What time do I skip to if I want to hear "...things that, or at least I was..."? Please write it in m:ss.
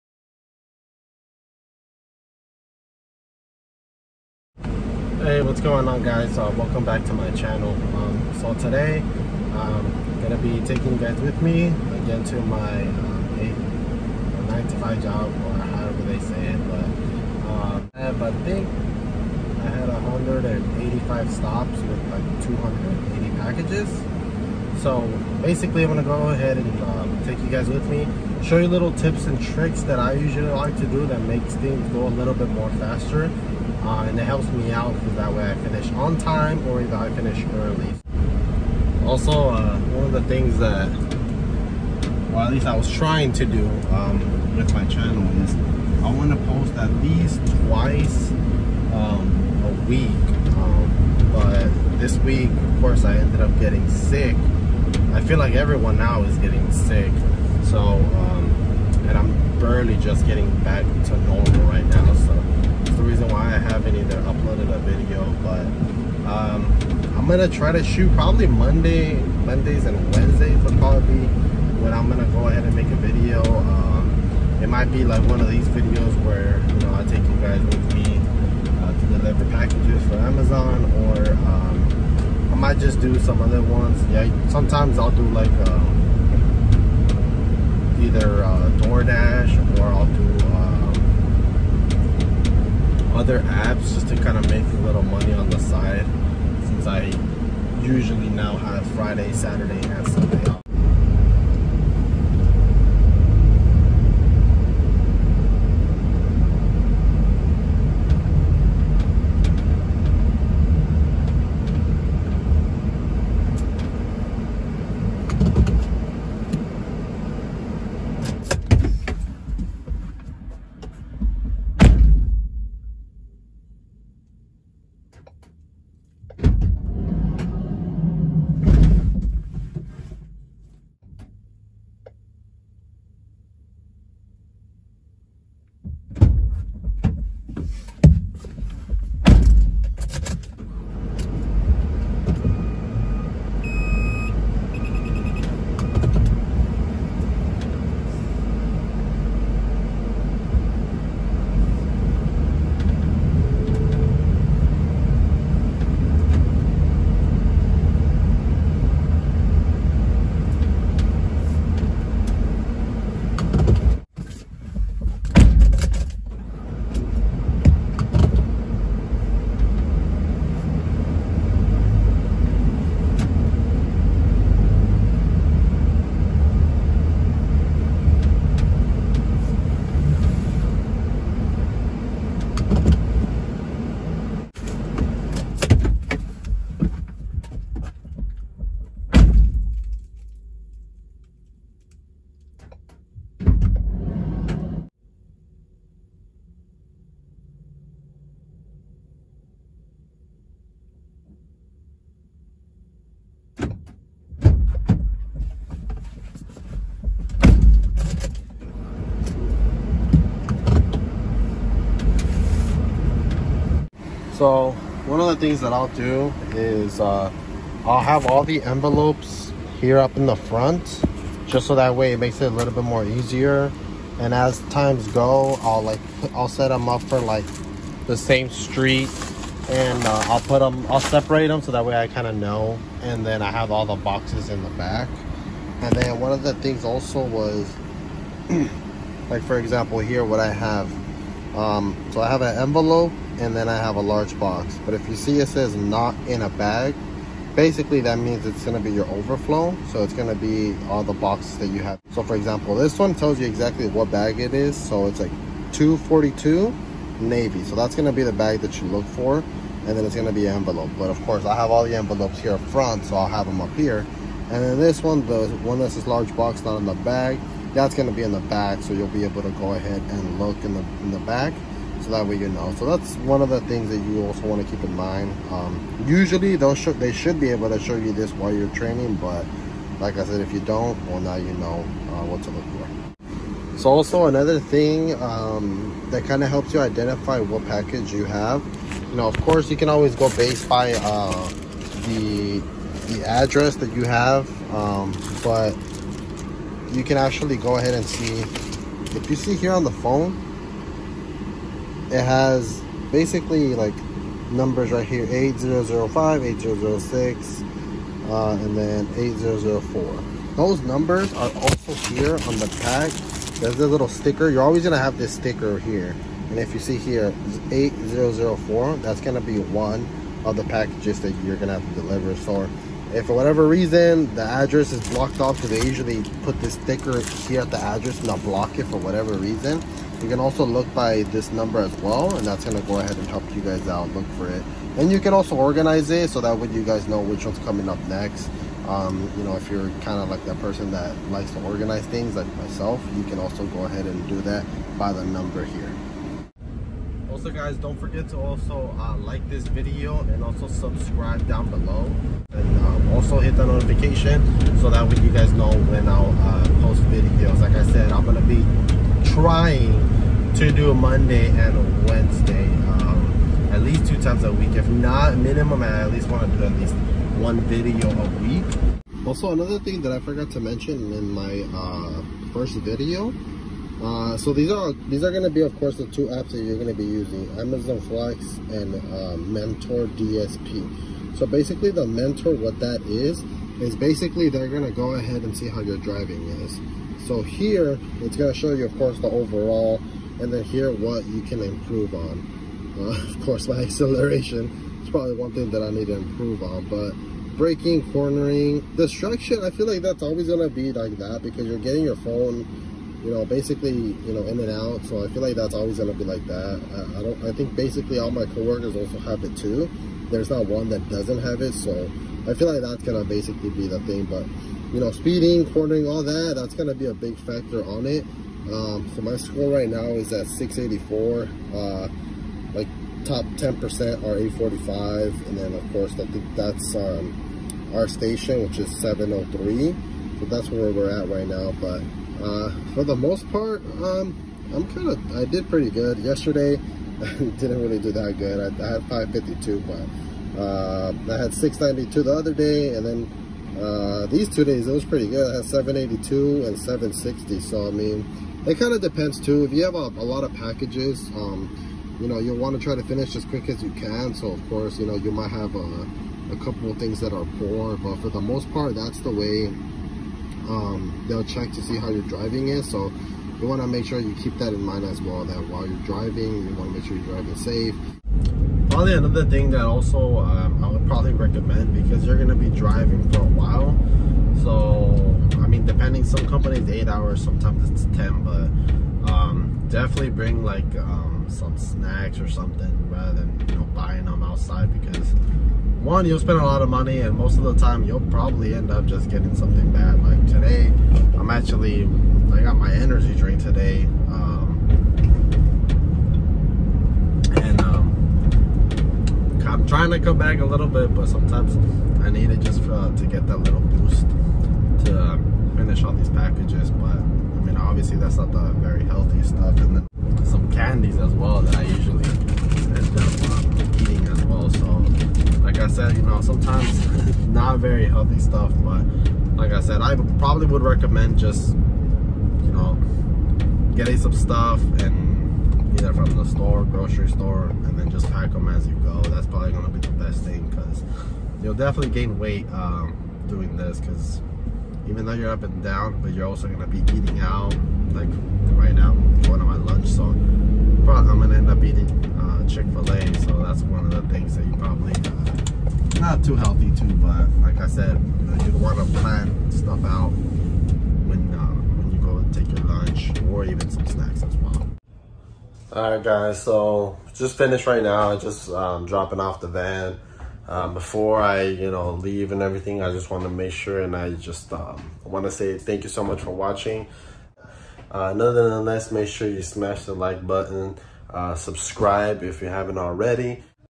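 0:40.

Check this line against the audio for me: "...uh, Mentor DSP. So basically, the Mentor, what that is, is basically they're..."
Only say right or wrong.
right.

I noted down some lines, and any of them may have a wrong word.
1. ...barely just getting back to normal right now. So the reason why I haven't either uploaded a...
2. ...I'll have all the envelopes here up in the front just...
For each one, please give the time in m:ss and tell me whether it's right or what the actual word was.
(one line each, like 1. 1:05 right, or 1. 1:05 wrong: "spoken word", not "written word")
1. 0:59 right
2. 3:37 right.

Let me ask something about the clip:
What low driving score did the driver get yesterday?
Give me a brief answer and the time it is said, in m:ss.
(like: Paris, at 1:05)
552, at 7:19.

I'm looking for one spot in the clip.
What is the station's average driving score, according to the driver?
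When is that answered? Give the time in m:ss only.
7:08.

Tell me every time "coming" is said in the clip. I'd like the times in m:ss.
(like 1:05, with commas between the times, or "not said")
5:37.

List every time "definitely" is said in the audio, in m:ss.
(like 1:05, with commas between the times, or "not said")
7:59, 8:51.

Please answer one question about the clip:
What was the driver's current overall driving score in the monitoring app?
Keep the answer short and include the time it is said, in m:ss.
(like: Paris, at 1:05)
684, at 7:00.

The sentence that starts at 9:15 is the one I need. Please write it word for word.
All right, guys, so just finished right now.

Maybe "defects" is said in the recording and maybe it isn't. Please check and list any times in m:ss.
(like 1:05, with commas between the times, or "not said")
not said.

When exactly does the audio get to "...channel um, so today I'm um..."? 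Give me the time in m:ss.
0:07.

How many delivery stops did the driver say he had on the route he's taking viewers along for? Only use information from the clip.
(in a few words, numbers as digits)
185.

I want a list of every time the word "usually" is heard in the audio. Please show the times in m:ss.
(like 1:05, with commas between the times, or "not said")
0:30, 1:37, 4:36, 5:25, 8:31.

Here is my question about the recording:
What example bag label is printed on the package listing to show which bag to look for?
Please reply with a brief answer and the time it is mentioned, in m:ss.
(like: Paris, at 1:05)
242 navy, at 4:15.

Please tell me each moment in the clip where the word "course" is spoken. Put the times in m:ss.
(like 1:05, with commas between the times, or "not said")
0:52, 4:21, 4:49, 6:15, 6:28, 6:33, 7:05, 7:34.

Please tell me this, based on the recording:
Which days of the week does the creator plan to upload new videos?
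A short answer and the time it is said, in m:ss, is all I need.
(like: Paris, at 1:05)
Mondays and Wednesdays, at 1:09.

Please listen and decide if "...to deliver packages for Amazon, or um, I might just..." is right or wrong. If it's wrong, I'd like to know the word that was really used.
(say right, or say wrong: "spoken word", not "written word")
right.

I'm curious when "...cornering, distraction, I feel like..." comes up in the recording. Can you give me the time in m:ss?
6:38.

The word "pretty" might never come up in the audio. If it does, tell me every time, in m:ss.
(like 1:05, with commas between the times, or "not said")
7:15, 7:25.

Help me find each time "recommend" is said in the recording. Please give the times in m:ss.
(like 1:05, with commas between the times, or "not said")
7:51, 8:40.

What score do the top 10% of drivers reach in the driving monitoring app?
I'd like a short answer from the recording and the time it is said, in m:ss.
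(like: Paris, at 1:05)
845, at 7:04.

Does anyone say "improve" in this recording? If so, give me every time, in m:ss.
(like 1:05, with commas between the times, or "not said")
6:31, 6:36.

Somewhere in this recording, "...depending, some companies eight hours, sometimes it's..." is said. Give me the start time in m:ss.
7:55.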